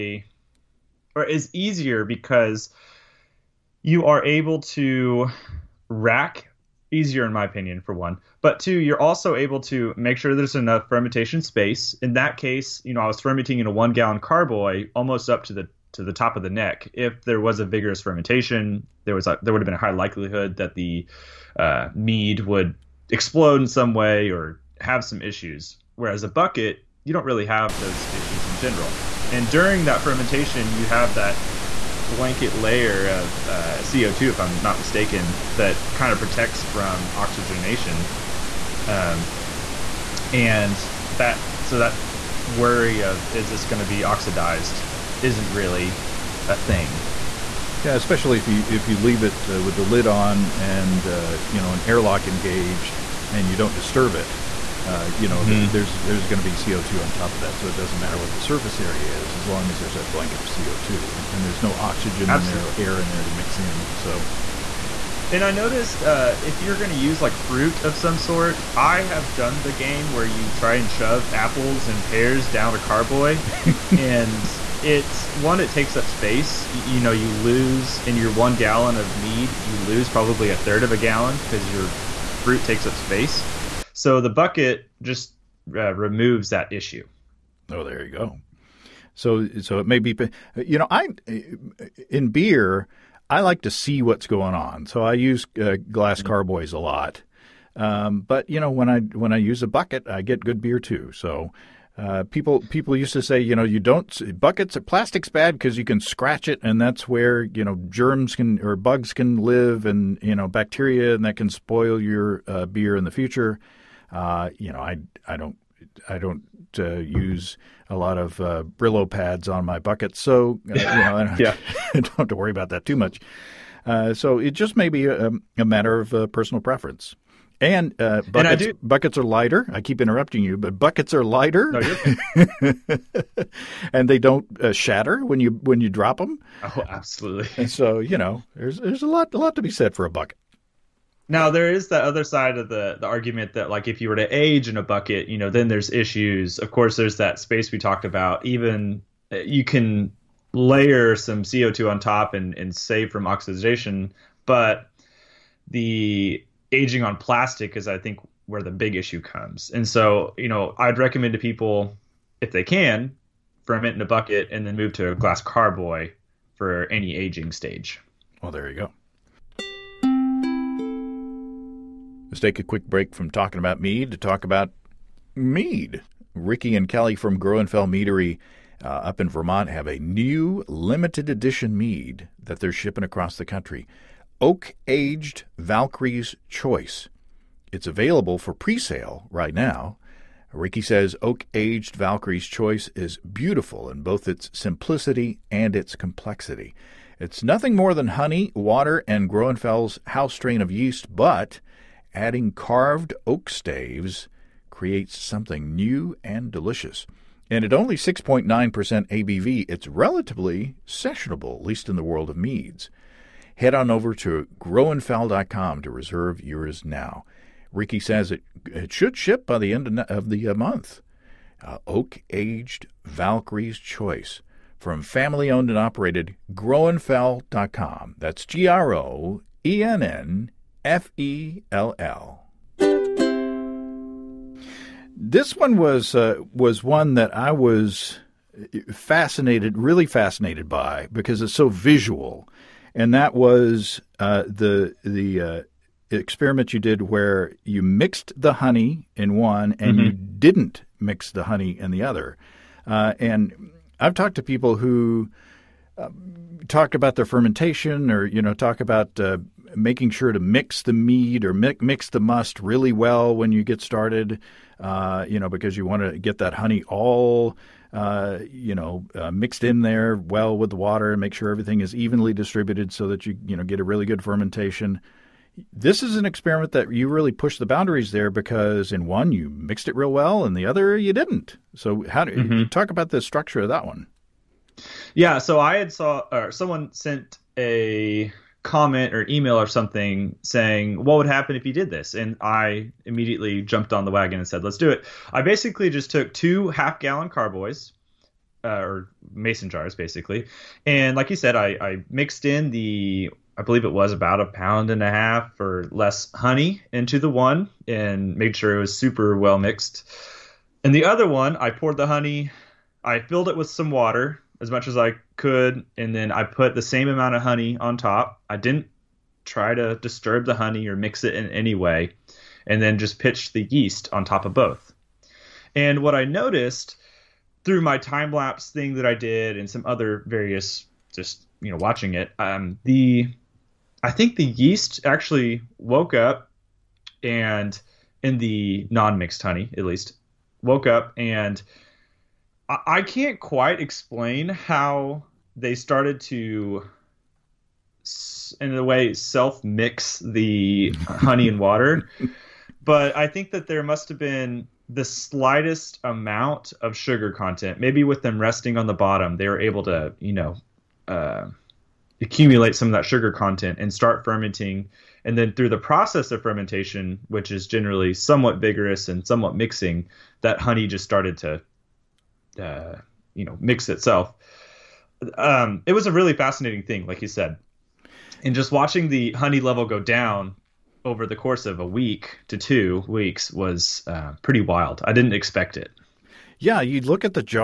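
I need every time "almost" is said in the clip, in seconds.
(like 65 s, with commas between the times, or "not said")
14 s.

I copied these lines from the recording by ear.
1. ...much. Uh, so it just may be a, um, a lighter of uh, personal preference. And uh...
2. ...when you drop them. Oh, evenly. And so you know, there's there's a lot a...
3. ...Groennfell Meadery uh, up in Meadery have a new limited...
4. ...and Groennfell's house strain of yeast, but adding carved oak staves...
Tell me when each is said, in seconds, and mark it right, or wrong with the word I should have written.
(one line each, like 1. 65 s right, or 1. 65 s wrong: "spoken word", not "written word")
1. 122 s wrong: "matter", not "lighter"
2. 135 s wrong: "absolutely", not "evenly"
3. 177 s wrong: "Vermont", not "Meadery"
4. 199 s right.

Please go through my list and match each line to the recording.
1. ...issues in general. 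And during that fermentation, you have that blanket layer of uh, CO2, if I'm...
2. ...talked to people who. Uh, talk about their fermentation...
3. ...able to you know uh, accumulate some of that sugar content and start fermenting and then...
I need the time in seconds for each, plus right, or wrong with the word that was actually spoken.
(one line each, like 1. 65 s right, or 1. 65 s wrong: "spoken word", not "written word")
1. 28 s right
2. 254 s right
3. 359 s right.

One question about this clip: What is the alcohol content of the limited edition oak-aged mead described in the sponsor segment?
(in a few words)
6.9%.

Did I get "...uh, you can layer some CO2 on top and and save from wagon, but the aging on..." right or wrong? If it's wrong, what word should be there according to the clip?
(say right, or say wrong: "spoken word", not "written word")
wrong: "oxidation", not "wagon".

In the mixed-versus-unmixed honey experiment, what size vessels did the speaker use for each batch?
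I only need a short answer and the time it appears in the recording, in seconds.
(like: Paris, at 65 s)
half gallon, at 296 s.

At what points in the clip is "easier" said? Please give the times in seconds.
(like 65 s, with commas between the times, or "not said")
1 s, 6 s.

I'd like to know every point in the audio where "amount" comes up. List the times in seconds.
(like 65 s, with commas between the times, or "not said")
317 s, 356 s.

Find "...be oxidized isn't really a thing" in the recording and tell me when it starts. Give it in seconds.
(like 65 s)
43 s.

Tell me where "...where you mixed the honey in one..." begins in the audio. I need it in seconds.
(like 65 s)
247 s.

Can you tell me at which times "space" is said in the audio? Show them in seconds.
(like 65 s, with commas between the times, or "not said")
11 s, 76 s, 82 s, 147 s.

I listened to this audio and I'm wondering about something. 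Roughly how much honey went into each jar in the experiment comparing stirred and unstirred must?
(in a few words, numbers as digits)
a pound and a half.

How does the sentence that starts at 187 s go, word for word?
It's available for pre sale right now.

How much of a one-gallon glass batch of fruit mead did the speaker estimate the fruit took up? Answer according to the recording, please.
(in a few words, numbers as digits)
a third of a gallon.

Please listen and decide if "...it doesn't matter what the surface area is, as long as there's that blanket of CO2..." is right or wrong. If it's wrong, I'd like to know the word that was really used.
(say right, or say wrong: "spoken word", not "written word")
right.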